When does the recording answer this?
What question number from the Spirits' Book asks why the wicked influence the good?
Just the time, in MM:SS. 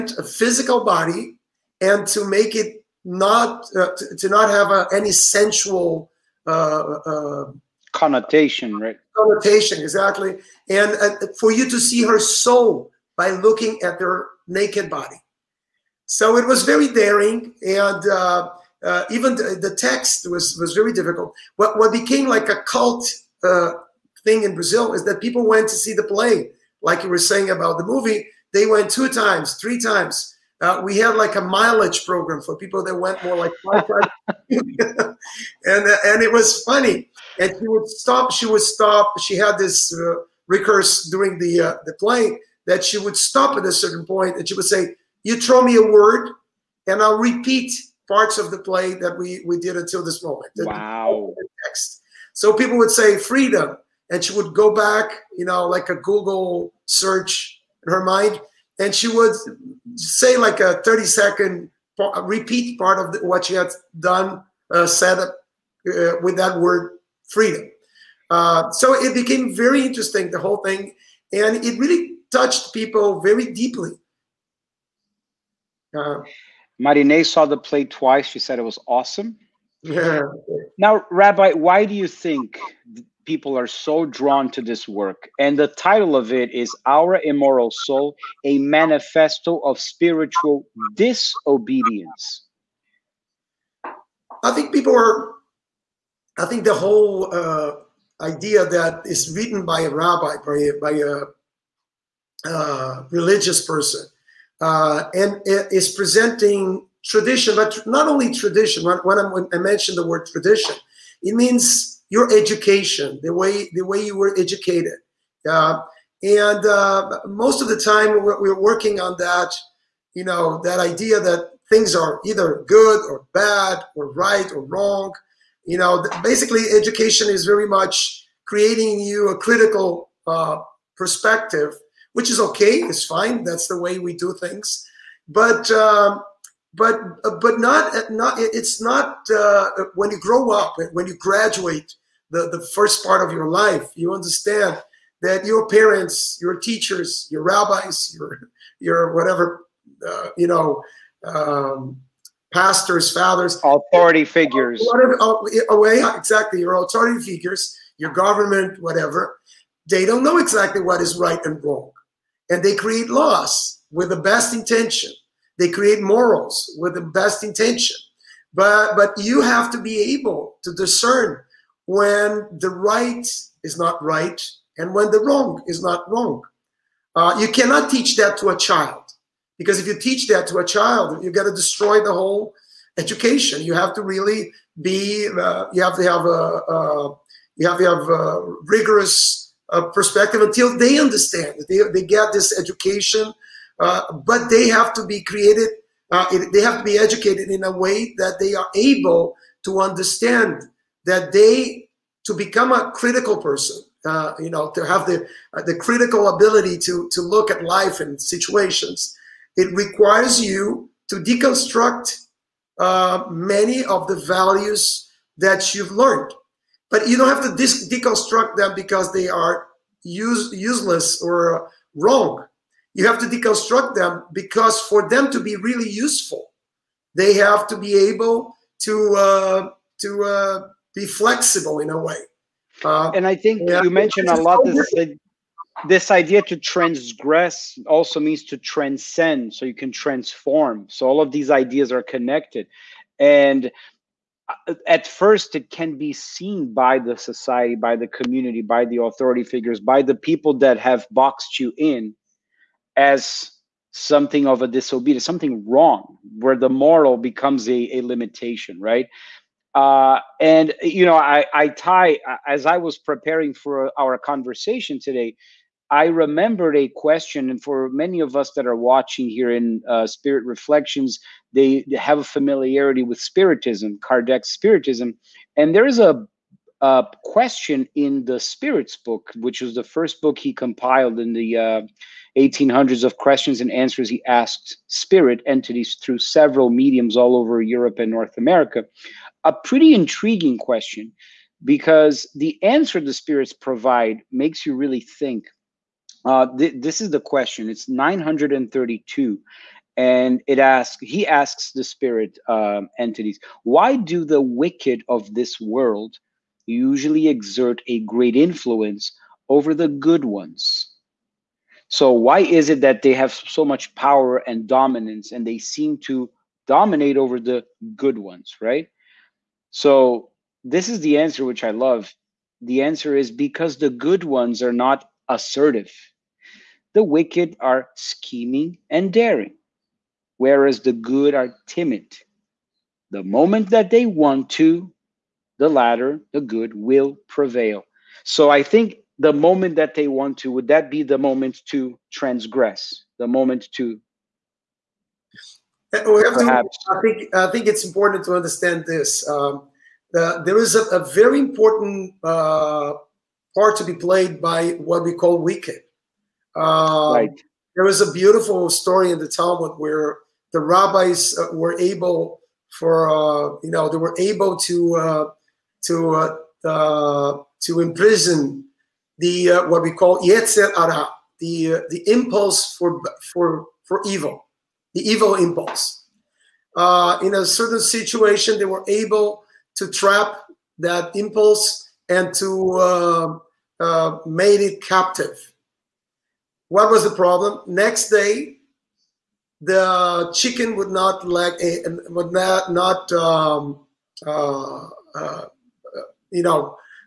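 04:57.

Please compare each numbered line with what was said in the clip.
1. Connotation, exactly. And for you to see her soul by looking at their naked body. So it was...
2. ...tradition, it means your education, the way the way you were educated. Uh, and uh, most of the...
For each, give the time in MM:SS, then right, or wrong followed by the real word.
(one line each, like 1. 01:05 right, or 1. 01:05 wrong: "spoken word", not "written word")
1. 00:09 right
2. 01:50 right.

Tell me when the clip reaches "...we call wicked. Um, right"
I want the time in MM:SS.
05:55.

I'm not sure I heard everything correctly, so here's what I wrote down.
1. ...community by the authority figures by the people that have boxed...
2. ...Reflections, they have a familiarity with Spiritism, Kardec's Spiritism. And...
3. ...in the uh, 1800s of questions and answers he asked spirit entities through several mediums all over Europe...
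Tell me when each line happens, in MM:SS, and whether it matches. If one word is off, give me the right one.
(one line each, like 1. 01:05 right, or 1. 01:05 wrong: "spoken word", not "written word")
1. 04:08 right
2. 04:30 right
3. 04:41 right.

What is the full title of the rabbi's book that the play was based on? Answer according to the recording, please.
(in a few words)
Our Immoral Soul.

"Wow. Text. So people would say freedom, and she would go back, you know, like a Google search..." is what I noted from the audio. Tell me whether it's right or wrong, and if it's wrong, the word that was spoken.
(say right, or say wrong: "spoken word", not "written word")
right.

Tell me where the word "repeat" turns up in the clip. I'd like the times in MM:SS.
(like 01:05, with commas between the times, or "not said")
00:47, 01:02.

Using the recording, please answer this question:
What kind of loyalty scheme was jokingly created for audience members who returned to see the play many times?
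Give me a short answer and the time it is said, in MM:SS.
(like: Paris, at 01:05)
mileage program, at 00:31.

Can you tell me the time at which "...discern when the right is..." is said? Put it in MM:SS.
02:50.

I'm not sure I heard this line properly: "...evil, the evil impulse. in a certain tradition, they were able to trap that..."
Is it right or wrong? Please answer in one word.
wrong.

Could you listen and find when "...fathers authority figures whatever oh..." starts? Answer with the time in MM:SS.
02:33.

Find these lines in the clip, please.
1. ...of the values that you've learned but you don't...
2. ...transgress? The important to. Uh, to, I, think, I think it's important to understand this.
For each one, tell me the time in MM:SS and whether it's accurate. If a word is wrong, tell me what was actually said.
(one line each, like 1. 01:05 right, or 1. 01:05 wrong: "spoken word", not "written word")
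1. 03:33 right
2. 05:42 wrong: "moment", not "important".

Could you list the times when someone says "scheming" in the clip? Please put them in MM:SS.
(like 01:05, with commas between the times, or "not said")
05:27.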